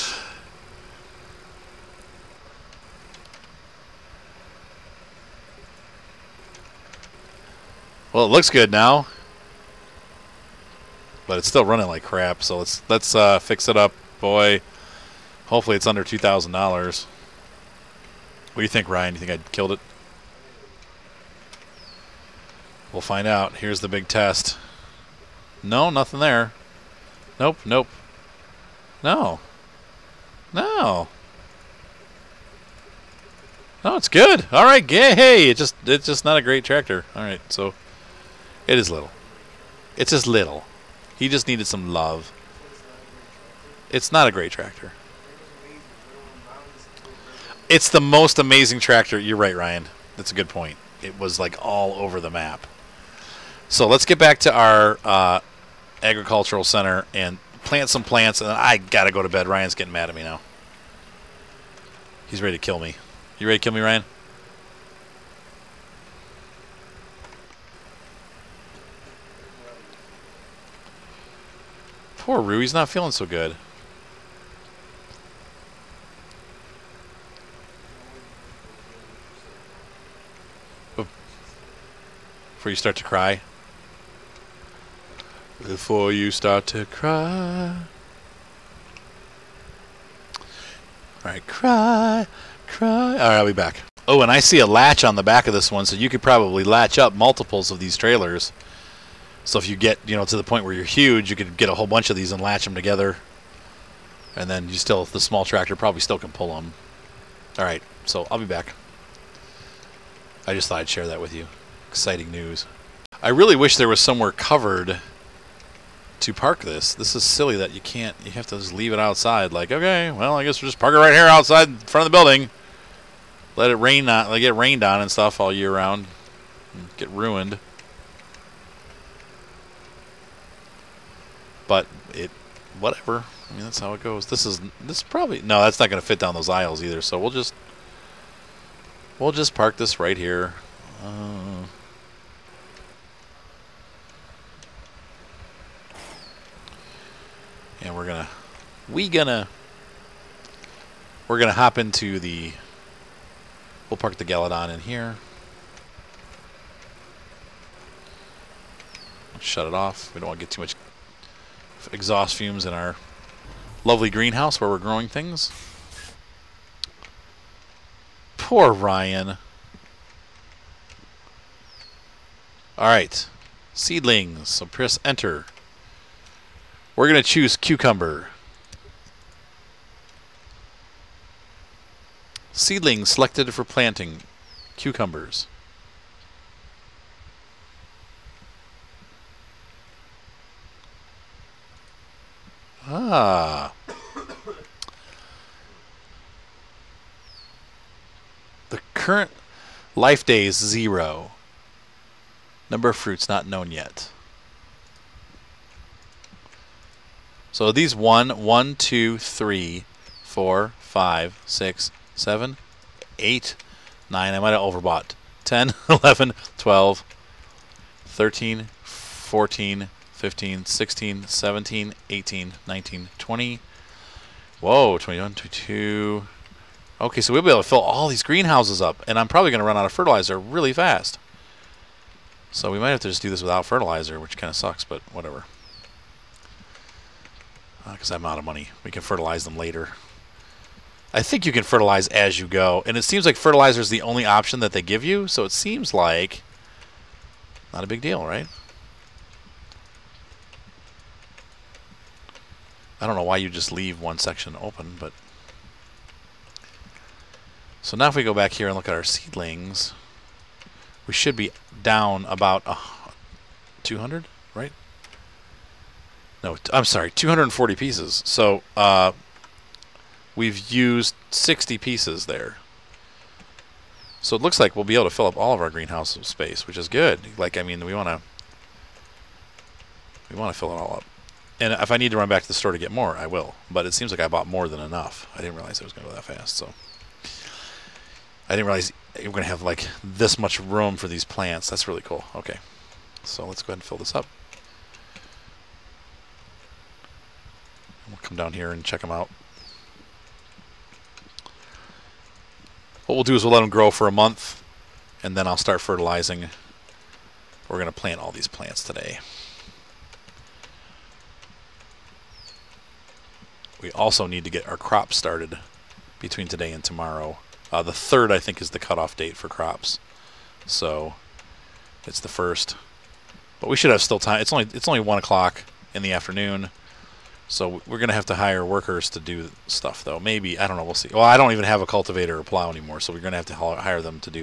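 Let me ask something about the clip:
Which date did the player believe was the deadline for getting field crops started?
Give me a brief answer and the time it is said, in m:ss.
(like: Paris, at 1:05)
The 3rd, at 5:17.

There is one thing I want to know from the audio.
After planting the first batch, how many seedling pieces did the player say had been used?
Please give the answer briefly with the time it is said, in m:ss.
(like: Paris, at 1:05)
60, at 4:31.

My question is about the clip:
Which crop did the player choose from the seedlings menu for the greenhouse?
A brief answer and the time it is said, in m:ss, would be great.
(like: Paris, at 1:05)
Cucumber, at 2:57.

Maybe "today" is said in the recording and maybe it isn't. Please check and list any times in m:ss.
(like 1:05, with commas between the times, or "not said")
5:08, 5:16.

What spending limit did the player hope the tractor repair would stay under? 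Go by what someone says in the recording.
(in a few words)
$2,000.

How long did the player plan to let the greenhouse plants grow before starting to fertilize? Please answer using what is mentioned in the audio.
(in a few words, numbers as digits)
A month.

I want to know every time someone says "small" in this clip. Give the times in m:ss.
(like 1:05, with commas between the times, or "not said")
1:45.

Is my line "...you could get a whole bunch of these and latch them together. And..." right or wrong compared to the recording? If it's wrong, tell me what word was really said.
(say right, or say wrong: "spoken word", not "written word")
right.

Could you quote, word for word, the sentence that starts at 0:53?
So let's get back to our uh, agricultural center and plant some plants.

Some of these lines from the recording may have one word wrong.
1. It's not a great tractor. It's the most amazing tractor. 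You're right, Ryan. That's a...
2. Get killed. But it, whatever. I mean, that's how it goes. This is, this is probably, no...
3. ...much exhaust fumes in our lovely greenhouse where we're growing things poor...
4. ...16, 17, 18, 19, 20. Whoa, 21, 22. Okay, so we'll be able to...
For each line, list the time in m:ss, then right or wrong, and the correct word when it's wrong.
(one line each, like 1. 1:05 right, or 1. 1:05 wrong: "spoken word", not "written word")
1. 0:43 right
2. 2:06 wrong: "ruined", not "killed"
3. 2:40 right
4. 3:40 right.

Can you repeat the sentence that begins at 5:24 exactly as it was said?
It's only, it's only 1 o'clock in the afternoon.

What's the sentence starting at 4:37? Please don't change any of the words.
Like, I mean, we want to we want to fill it all up.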